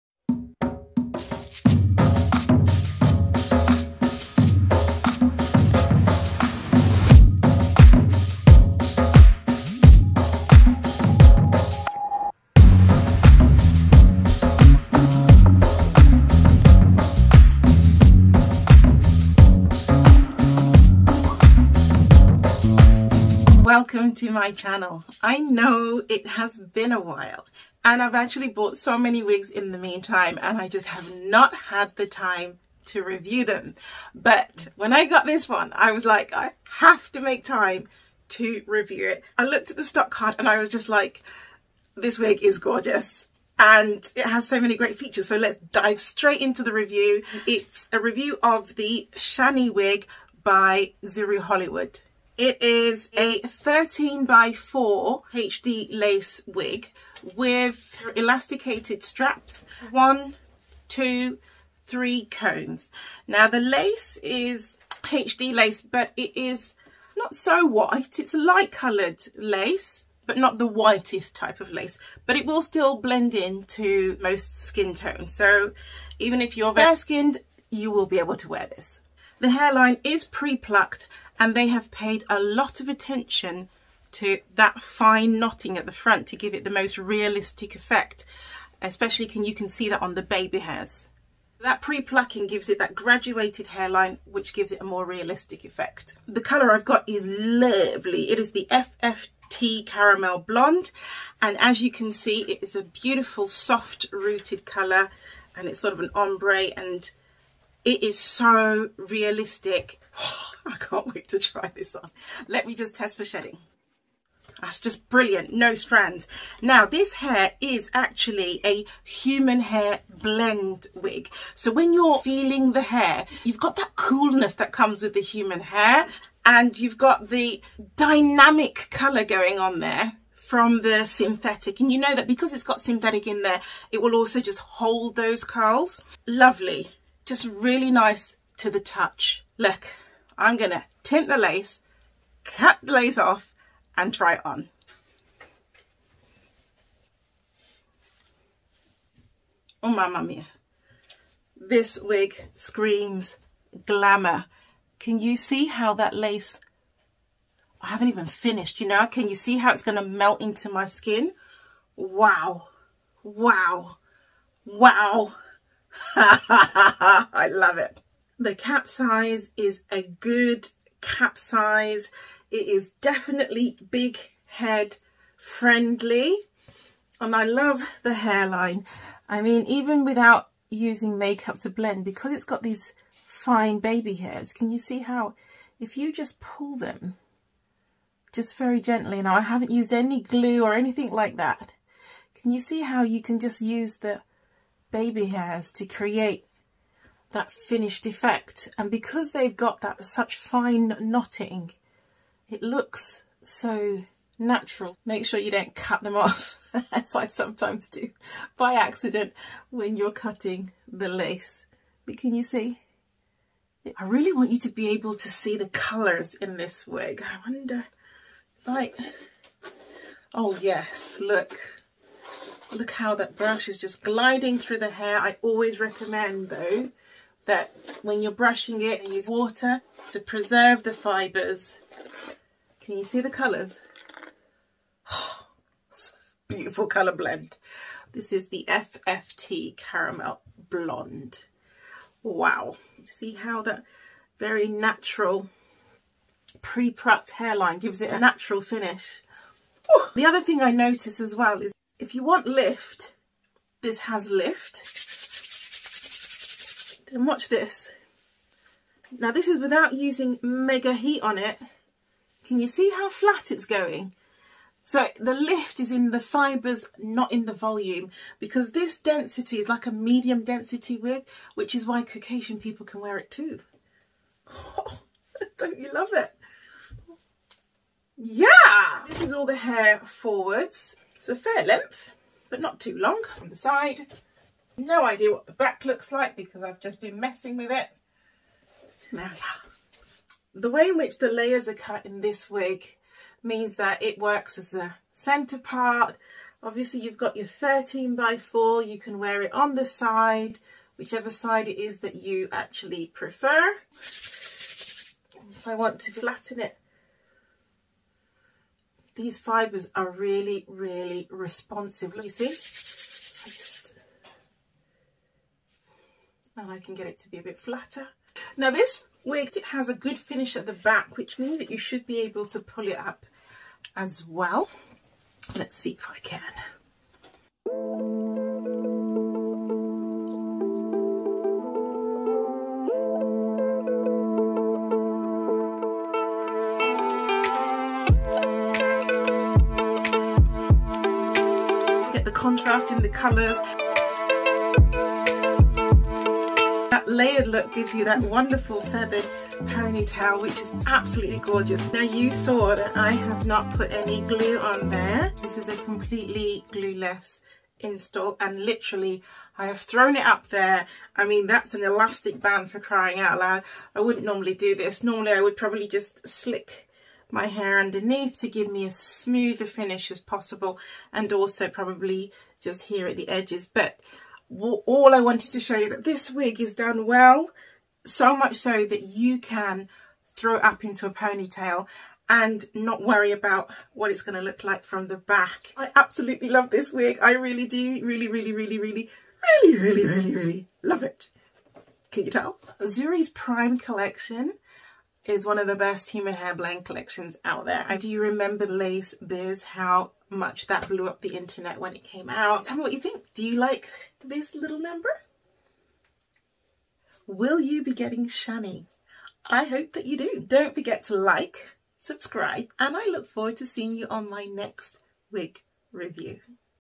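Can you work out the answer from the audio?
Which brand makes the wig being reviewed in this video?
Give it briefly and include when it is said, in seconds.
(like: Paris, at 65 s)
Zury Hollywood, at 51 s.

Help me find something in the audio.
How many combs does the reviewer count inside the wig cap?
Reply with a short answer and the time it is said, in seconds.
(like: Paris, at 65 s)
3, at 61 s.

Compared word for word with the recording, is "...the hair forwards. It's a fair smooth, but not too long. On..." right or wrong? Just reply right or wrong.
wrong.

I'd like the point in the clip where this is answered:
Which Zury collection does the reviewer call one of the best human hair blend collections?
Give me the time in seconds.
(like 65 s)
393 s.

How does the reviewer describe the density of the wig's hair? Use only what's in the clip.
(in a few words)
Medium density.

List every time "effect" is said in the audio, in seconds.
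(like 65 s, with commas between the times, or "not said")
87 s, 95 s, 198 s.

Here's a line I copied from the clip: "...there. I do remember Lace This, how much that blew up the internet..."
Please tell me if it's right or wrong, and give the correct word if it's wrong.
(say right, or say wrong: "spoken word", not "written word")
wrong: "Biz", not "This".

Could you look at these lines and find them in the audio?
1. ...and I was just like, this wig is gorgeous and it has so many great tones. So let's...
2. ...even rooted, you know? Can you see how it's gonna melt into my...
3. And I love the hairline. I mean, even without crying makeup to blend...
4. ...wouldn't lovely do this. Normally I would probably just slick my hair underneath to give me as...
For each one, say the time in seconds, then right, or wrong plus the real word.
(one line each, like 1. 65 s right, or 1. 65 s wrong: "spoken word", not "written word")
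1. 40 s wrong: "features", not "tones"
2. 158 s wrong: "finished", not "rooted"
3. 177 s wrong: "using", not "crying"
4. 363 s wrong: "normally", not "lovely".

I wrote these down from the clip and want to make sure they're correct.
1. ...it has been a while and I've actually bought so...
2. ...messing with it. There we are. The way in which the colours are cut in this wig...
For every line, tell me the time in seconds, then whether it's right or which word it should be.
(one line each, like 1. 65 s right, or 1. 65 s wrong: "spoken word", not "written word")
1. 26 s right
2. 287 s wrong: "layers", not "colours".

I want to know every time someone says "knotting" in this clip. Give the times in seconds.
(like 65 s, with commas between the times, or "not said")
85 s, 200 s.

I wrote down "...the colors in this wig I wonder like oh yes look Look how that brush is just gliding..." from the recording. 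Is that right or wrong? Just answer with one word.
right.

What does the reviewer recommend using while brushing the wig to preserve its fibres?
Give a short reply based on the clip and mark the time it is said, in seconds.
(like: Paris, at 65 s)
Water, at 229 s.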